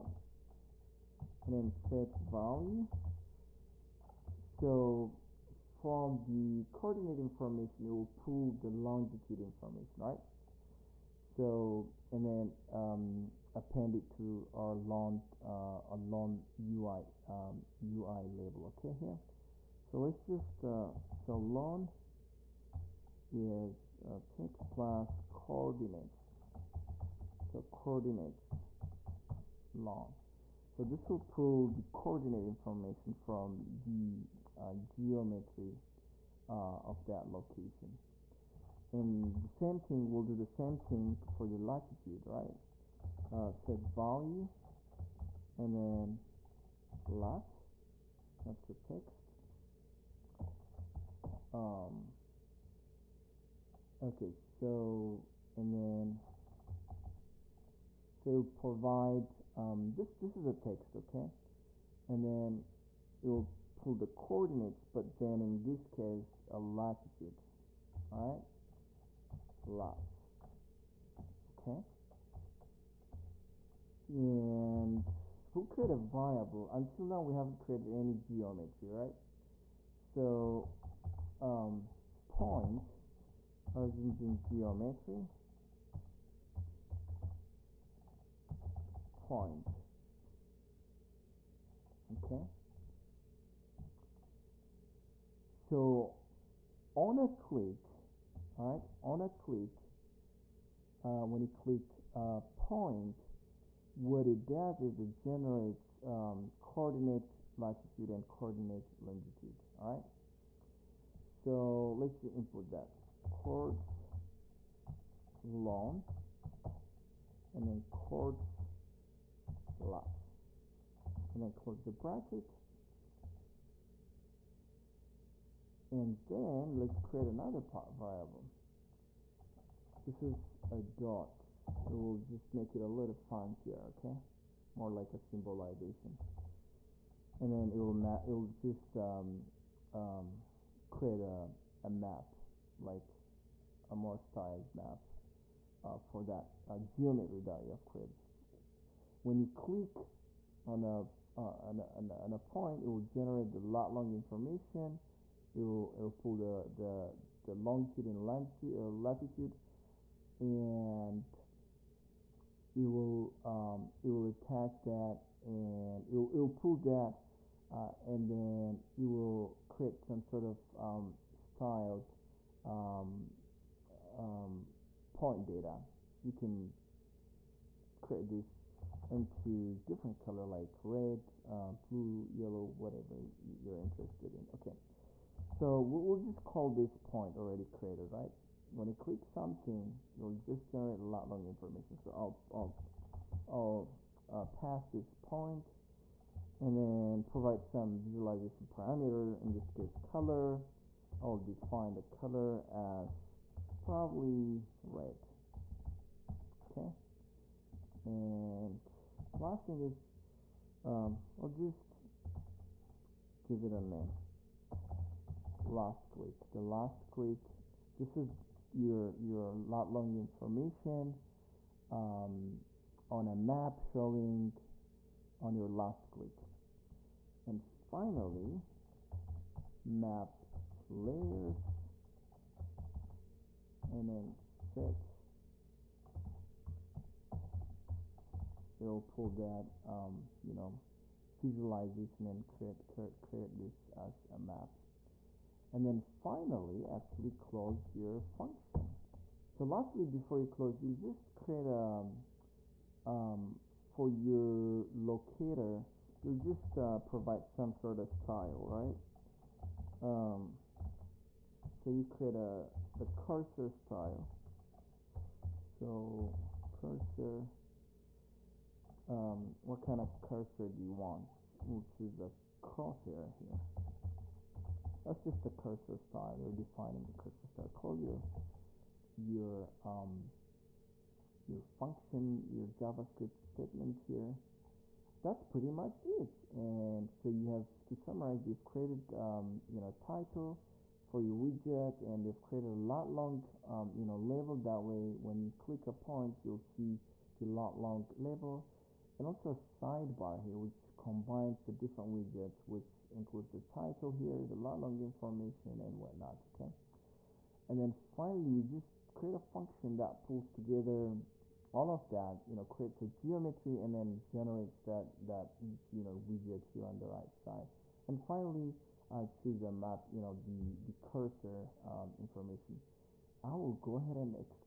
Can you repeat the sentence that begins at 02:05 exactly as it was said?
And then let's create another variable.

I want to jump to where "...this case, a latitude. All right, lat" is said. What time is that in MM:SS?
01:05.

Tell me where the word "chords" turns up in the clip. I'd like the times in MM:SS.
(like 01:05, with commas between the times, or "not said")
01:53, 01:57.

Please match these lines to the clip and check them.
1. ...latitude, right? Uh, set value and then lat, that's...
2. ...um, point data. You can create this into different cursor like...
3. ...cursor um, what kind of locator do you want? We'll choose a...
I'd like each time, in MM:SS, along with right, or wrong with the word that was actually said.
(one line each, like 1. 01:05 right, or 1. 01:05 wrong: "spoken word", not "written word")
1. 00:41 right
2. 02:54 wrong: "color", not "cursor"
3. 04:26 wrong: "cursor", not "locator".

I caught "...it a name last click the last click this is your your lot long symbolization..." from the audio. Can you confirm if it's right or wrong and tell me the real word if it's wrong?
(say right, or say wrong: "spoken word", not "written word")
wrong: "information", not "symbolization".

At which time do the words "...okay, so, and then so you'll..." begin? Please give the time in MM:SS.
00:54.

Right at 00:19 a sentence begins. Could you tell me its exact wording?
So let's just, uh, so long is uh, text plus coordinates.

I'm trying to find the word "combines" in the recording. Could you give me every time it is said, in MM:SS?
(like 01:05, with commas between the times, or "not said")
05:00.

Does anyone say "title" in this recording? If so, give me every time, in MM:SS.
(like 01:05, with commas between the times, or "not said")
04:49, 05:03.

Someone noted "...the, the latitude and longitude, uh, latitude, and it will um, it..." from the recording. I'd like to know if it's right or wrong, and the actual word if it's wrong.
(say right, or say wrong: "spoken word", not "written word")
wrong: "longitude", not "latitude".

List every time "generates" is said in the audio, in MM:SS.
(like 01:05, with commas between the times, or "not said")
01:45, 02:32, 03:10, 05:14.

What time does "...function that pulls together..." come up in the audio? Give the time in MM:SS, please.
05:09.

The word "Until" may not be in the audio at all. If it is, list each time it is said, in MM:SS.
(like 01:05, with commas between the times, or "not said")
01:16.